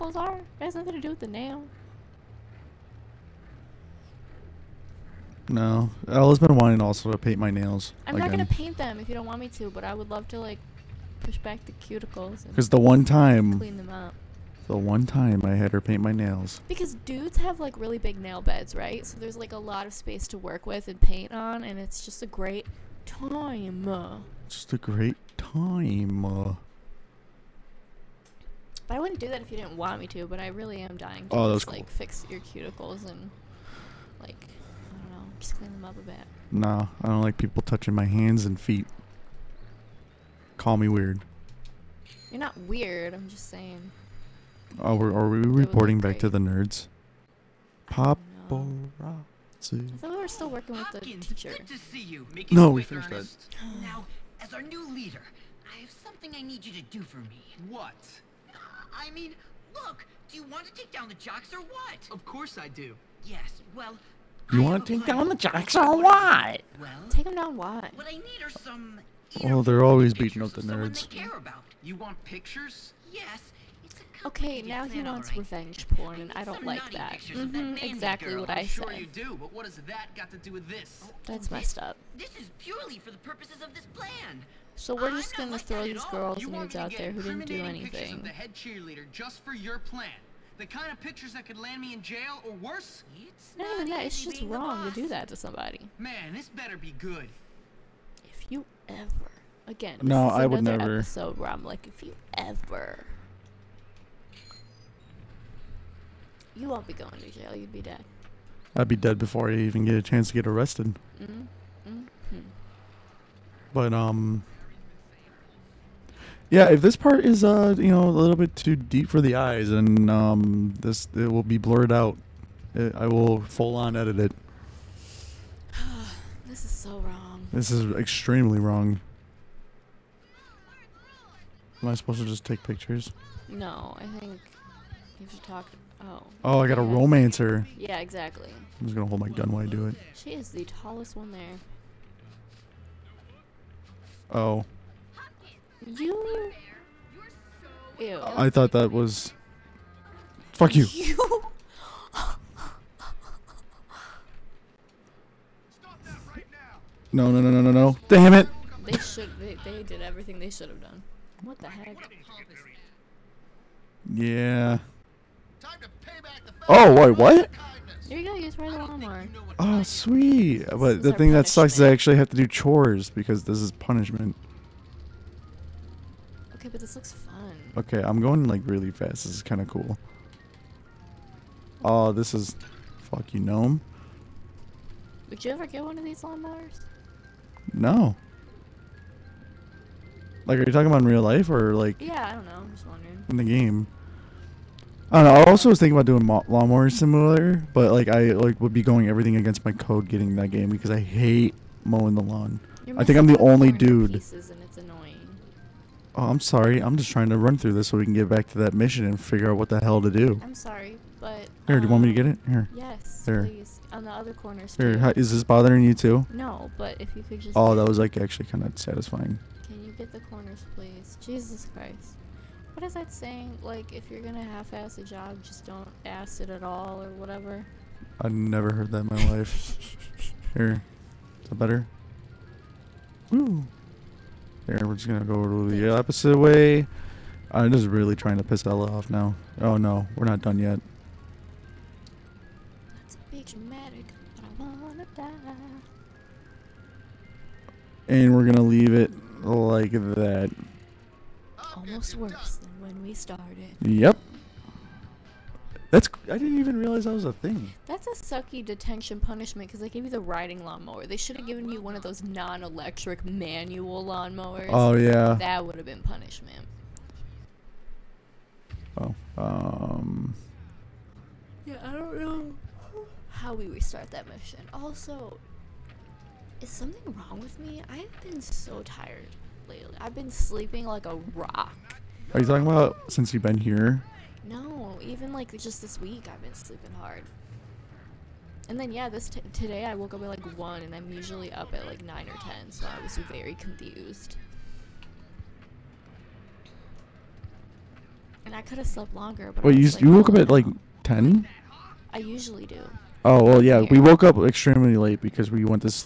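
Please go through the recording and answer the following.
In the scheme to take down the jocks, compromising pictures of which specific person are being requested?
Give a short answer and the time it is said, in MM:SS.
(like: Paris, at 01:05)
the head cheerleader, at 01:28.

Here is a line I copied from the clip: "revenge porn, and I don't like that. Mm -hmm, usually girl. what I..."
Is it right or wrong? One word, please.
wrong.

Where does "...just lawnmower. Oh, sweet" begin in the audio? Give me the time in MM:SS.
02:48.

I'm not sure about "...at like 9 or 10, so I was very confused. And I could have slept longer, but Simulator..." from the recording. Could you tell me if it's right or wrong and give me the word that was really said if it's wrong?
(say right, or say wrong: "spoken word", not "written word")
wrong: "Wait", not "Simulator".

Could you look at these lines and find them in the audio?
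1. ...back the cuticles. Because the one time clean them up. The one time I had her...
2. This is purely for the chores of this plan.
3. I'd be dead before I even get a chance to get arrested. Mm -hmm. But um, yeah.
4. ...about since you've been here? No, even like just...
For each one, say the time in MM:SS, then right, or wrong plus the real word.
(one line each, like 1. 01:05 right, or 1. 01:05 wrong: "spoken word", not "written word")
1. 00:11 right
2. 01:22 wrong: "purposes", not "chores"
3. 01:48 right
4. 04:42 right.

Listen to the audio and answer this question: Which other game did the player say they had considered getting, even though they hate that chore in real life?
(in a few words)
Lawnmower Simulator.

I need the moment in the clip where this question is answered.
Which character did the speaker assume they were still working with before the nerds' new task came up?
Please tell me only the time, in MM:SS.
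00:50.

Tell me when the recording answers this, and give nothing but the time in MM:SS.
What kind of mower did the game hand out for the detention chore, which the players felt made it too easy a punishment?
04:20.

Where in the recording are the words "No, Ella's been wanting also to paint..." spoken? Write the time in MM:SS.
00:05.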